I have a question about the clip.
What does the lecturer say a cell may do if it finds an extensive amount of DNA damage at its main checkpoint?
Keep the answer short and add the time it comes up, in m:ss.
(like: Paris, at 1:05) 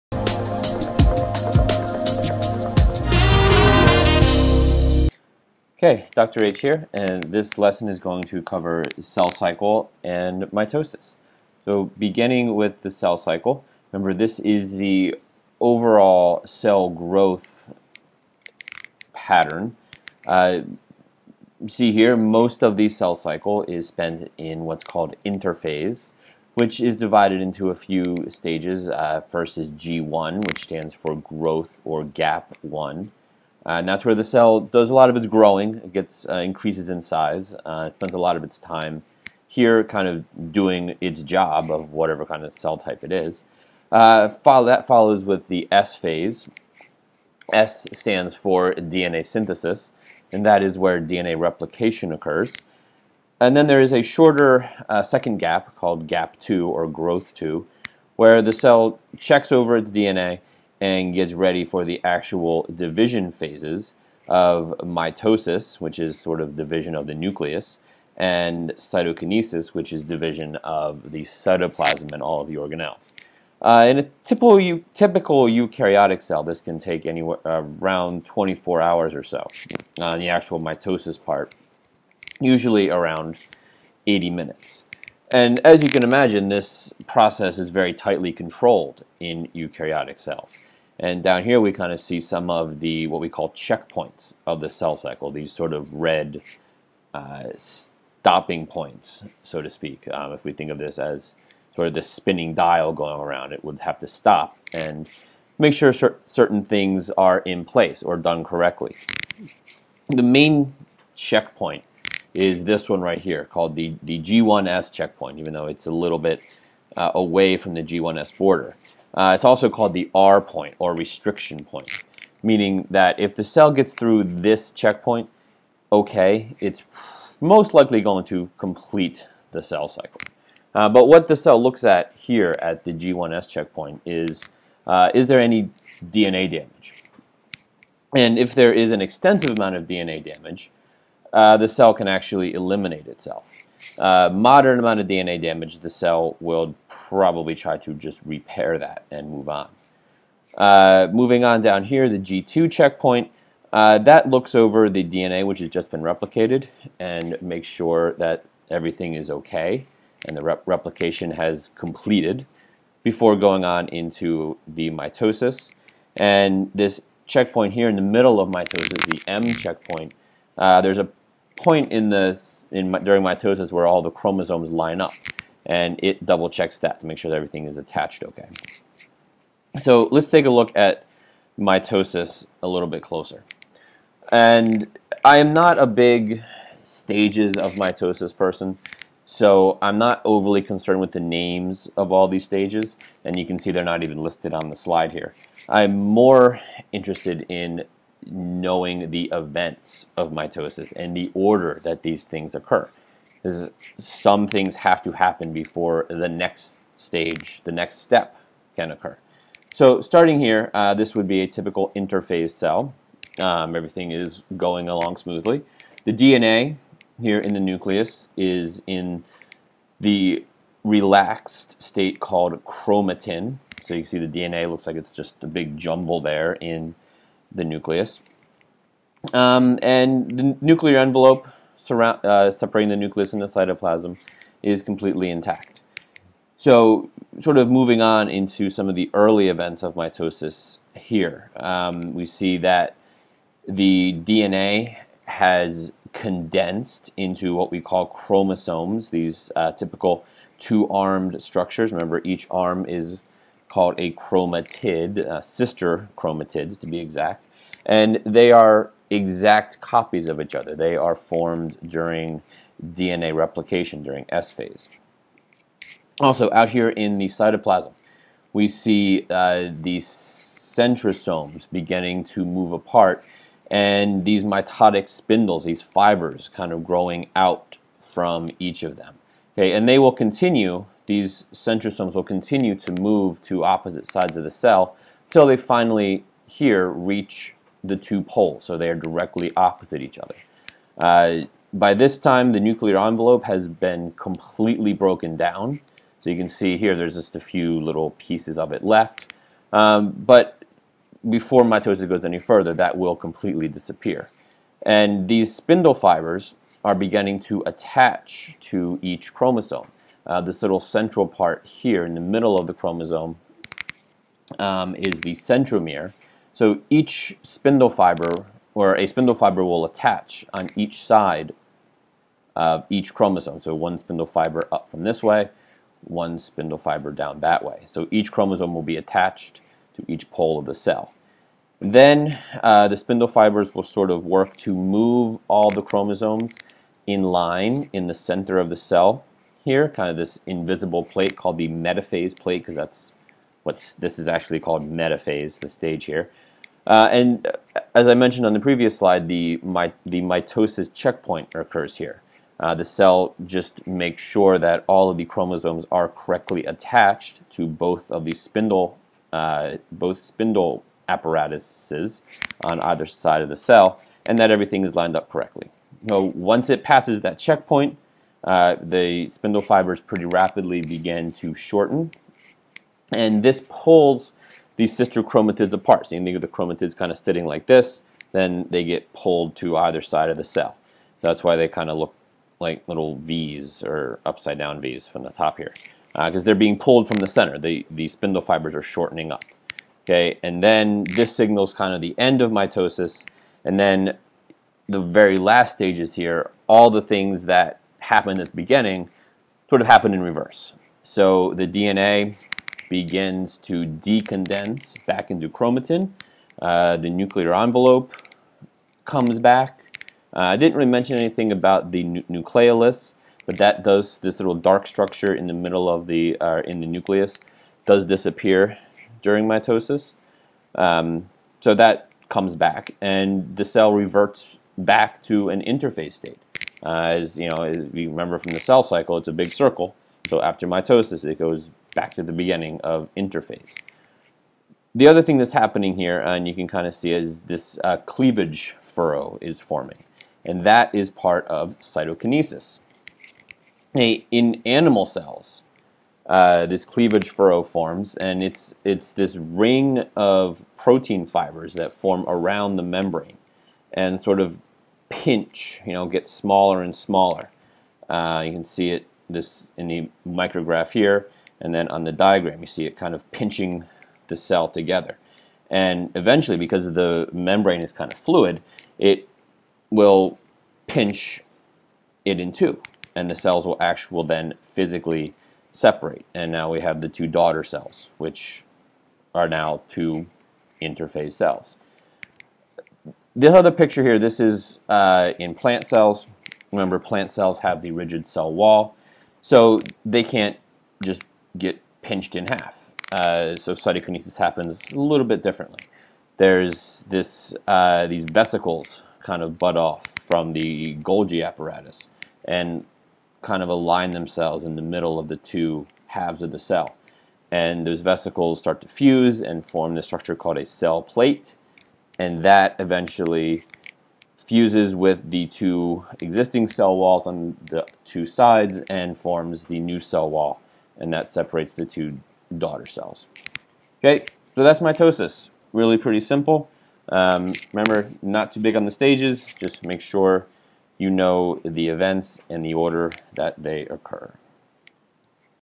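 eliminate itself, at 2:22.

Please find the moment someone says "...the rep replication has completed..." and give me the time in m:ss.
2:40.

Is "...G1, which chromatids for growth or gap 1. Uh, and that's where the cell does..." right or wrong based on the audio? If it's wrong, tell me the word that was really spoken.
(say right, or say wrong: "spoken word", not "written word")
wrong: "stands", not "chromatids".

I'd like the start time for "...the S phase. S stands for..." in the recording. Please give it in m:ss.
0:45.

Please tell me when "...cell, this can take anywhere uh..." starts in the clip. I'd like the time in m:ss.
1:16.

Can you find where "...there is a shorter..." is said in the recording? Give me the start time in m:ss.
0:53.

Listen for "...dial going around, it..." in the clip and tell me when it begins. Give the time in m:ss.
1:42.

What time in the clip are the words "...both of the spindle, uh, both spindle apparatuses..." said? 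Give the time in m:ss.
5:57.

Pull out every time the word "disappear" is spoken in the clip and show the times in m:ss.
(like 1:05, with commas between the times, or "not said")
5:03, 6:58.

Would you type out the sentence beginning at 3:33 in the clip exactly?
Um, everything is going along smoothly.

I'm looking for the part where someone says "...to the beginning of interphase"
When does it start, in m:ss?
7:12.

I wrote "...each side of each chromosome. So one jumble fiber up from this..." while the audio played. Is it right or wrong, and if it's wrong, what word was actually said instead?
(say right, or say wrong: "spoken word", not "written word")
wrong: "spindle", not "jumble".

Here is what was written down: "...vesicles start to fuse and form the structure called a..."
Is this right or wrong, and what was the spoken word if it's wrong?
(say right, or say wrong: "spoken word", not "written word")
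right.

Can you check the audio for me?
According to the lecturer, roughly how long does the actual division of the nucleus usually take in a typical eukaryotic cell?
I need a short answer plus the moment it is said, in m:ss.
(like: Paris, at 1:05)
80 minutes, at 1:22.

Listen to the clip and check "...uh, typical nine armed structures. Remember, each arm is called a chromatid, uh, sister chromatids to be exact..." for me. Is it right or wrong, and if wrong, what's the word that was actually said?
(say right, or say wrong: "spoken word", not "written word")
wrong: "two", not "nine".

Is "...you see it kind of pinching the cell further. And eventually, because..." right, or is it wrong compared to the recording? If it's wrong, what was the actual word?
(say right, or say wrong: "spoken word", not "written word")
wrong: "together", not "further".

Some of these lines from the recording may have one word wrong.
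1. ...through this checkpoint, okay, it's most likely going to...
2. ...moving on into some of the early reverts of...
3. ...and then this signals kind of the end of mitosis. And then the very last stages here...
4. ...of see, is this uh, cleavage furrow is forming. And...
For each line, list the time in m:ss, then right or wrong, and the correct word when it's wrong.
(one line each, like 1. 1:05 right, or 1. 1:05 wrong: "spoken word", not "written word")
1. 2:03 right
2. 3:57 wrong: "events", not "reverts"
3. 6:30 right
4. 7:16 right.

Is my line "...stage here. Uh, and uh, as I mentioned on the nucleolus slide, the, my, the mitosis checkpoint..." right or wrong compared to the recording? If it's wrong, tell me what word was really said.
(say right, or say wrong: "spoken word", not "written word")
wrong: "previous", not "nucleolus".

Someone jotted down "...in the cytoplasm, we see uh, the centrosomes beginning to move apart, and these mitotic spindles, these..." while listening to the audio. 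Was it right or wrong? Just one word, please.
right.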